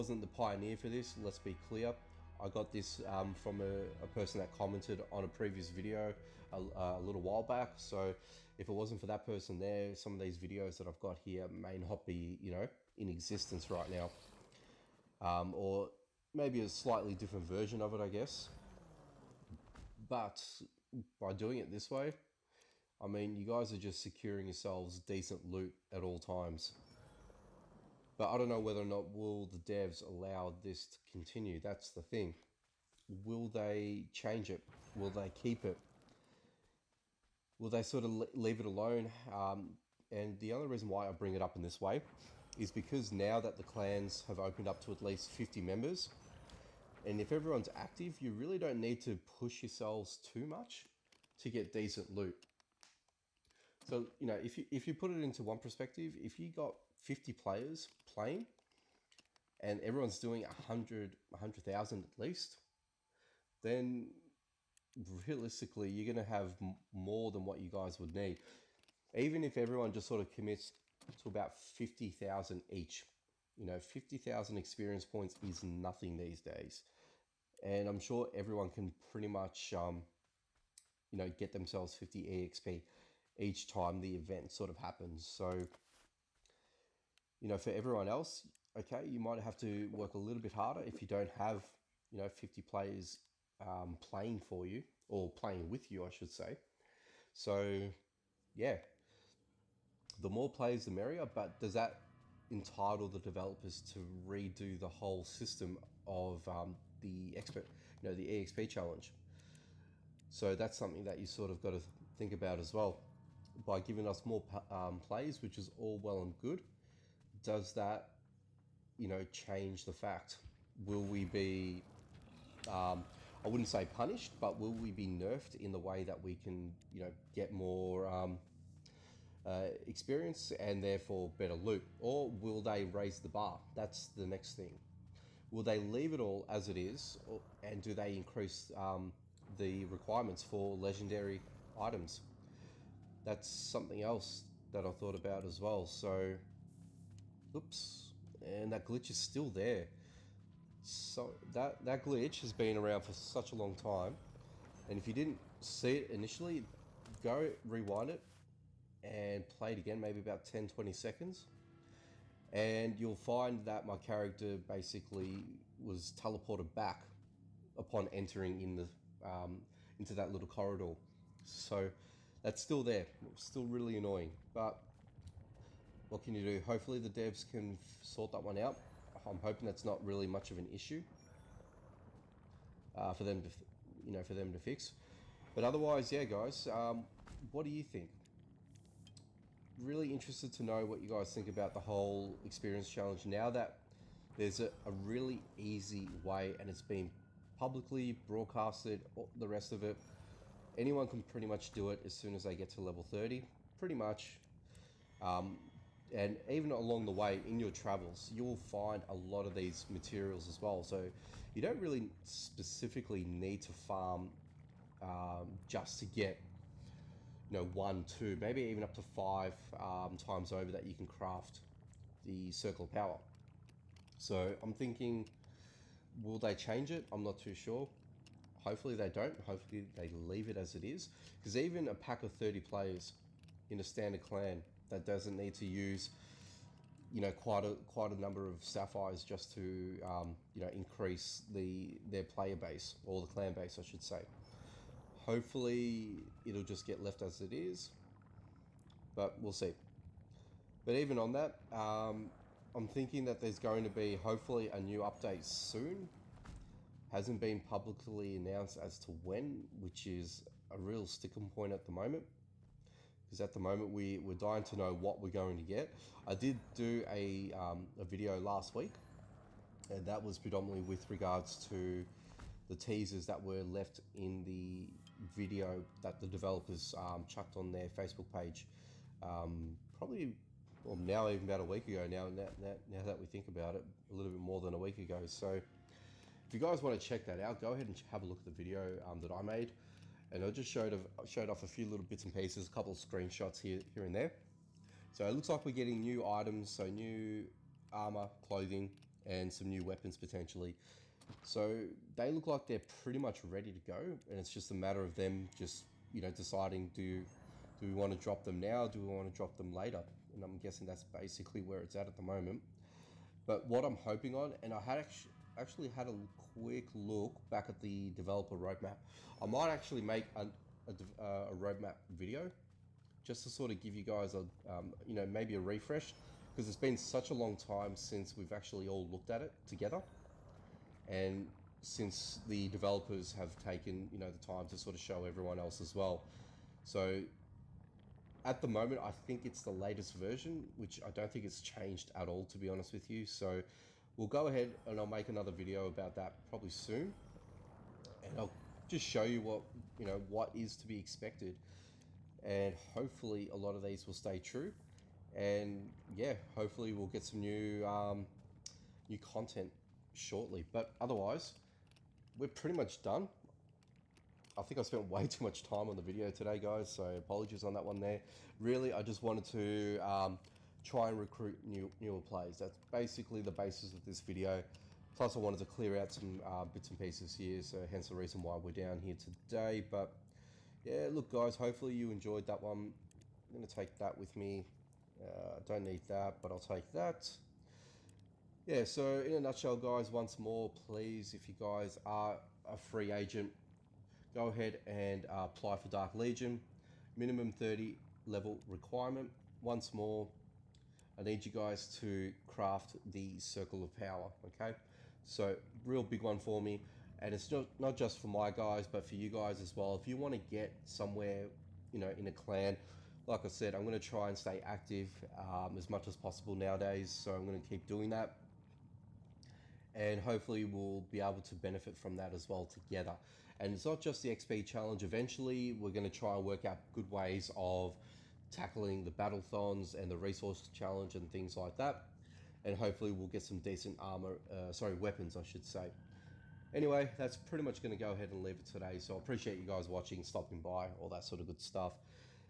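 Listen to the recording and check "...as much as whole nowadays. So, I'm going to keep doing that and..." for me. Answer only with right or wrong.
wrong.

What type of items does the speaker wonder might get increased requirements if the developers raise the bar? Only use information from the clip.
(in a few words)
legendary items.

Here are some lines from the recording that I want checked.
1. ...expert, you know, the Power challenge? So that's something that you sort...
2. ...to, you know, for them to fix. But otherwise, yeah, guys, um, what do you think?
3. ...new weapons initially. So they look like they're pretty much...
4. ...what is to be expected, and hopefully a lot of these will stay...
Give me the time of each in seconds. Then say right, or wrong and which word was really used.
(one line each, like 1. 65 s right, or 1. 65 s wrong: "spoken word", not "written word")
1. 107 s wrong: "EXP", not "Power"
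2. 183 s right
3. 299 s wrong: "potentially", not "initially"
4. 350 s right.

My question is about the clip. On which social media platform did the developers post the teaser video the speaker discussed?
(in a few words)
Facebook.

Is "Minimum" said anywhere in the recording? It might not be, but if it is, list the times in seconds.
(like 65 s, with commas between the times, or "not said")
397 s.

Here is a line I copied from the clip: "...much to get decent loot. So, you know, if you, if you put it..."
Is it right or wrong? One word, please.
right.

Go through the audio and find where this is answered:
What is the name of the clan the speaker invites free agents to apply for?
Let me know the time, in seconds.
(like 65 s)
395 s.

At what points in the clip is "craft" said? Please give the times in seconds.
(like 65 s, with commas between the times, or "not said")
221 s, 402 s.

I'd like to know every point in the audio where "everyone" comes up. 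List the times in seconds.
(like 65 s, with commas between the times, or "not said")
47 s, 59 s, 69 s, 78 s, 87 s, 335 s.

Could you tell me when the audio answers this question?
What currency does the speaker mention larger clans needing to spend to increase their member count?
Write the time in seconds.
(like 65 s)
238 s.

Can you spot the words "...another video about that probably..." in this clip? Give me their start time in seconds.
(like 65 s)
345 s.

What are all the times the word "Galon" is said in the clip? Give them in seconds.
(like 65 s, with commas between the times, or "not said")
not said.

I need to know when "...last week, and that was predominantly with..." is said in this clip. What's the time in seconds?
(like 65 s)
268 s.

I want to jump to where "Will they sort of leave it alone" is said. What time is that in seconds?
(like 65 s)
37 s.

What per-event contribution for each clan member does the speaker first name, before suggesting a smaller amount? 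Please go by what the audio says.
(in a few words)
100,000.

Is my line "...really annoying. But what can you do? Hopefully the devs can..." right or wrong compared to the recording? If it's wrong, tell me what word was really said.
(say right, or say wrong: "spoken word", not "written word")
right.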